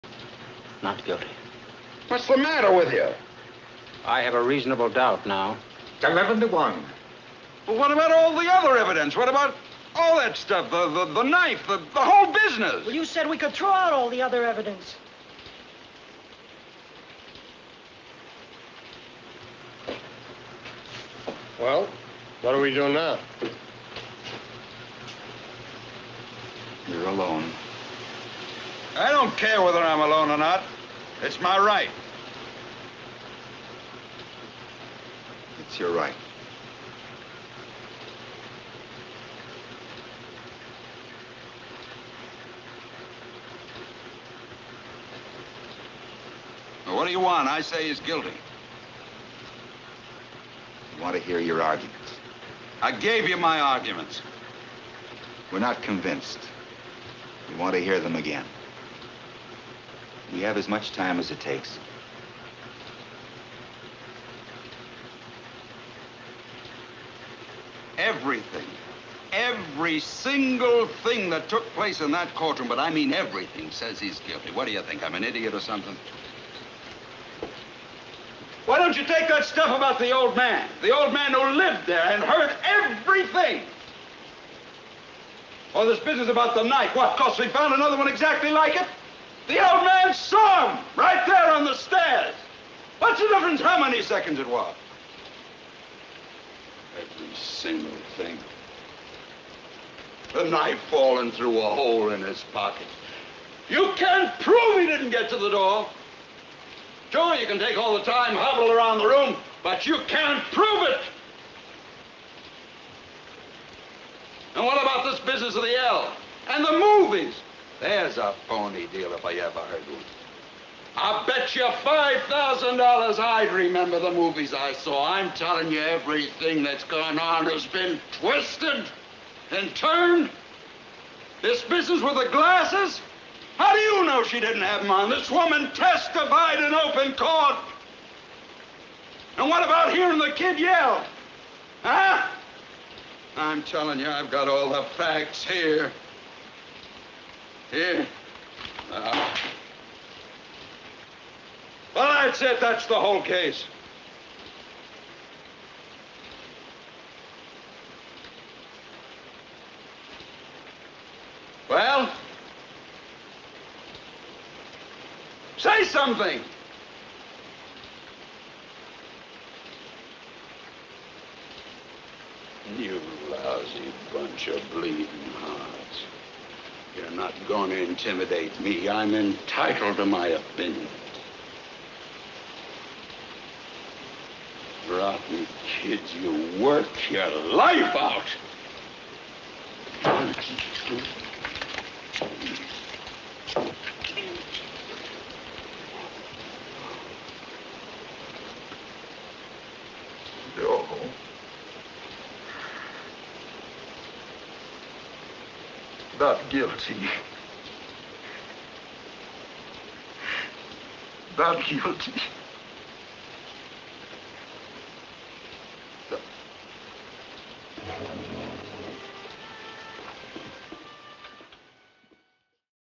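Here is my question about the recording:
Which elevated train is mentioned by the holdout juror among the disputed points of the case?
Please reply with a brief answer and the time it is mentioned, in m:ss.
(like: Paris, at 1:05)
the L, at 1:55.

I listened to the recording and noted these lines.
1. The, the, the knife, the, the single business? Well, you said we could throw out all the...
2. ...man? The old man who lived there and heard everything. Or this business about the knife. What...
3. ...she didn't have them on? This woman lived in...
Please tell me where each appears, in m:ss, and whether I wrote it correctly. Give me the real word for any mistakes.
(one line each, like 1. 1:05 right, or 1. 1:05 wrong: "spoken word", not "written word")
1. 0:10 wrong: "whole", not "single"
2. 1:20 right
3. 2:14 wrong: "testified", not "lived".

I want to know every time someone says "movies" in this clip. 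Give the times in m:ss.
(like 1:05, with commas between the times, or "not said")
1:56, 2:04.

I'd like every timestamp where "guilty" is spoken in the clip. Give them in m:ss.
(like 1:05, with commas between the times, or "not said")
0:01, 0:48, 1:14, 3:26, 3:31.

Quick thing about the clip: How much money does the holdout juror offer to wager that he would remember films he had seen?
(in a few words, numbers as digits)
$5,000.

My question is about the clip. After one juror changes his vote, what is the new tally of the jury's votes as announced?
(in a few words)
11 to 1.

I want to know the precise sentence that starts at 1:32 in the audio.
What's the difference how many seconds it was?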